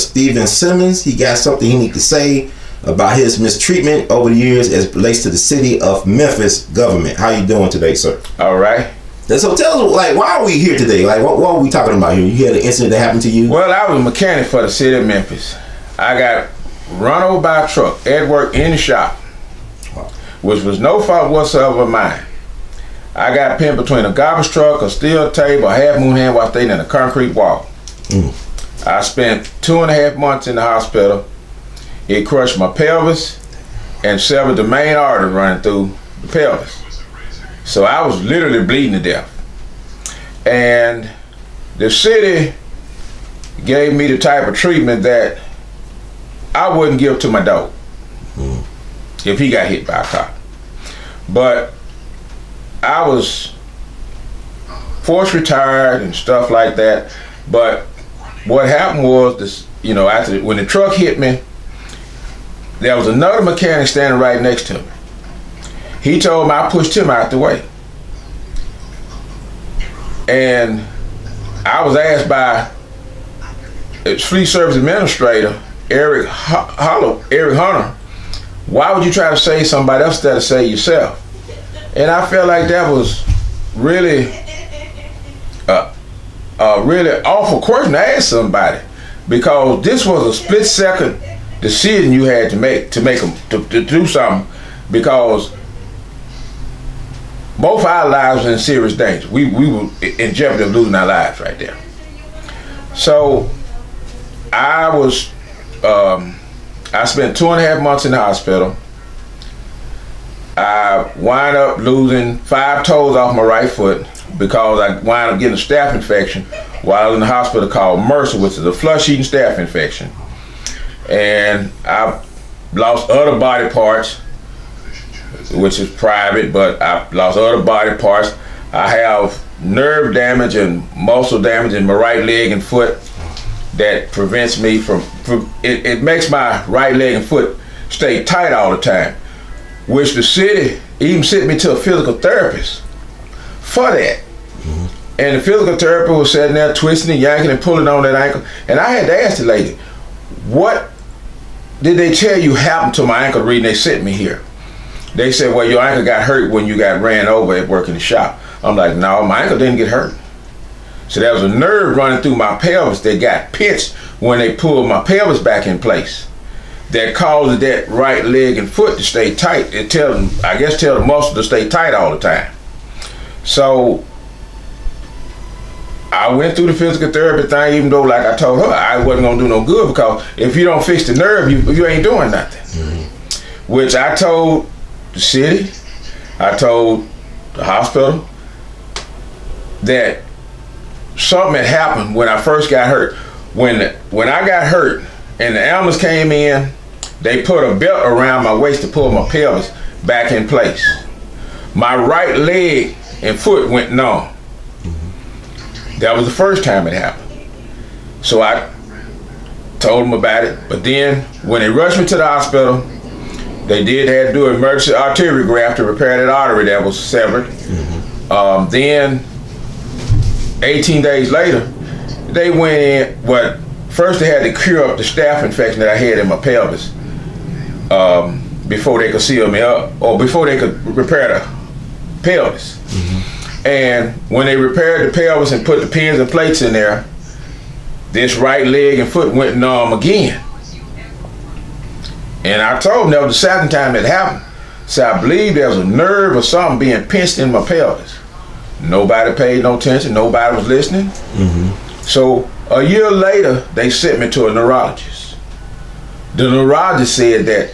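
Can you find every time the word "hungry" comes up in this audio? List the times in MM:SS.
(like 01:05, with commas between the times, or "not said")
not said.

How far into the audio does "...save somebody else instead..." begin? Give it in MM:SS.
01:19.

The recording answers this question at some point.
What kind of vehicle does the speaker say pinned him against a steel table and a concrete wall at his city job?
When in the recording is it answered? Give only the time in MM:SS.
00:24.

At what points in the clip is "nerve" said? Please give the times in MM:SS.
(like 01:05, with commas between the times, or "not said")
02:09, 02:41, 03:01, 04:05.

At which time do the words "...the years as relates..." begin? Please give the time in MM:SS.
00:04.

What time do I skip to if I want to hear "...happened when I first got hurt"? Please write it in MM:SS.
03:11.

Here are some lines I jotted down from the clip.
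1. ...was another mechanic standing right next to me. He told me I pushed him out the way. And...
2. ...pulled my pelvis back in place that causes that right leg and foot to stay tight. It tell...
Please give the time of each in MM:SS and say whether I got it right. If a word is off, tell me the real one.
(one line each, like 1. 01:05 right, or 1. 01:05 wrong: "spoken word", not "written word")
1. 01:02 right
2. 02:44 right.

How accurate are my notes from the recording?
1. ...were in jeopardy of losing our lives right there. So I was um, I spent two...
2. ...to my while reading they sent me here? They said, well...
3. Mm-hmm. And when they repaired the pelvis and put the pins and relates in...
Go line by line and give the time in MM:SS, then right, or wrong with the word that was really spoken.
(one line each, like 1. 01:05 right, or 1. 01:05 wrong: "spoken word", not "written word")
1. 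01:39 right
2. 02:32 wrong: "ankle", not "while"
3. 03:52 wrong: "plates", not "relates".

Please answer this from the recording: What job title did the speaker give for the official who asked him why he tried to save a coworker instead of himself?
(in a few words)
Fleet service administrator.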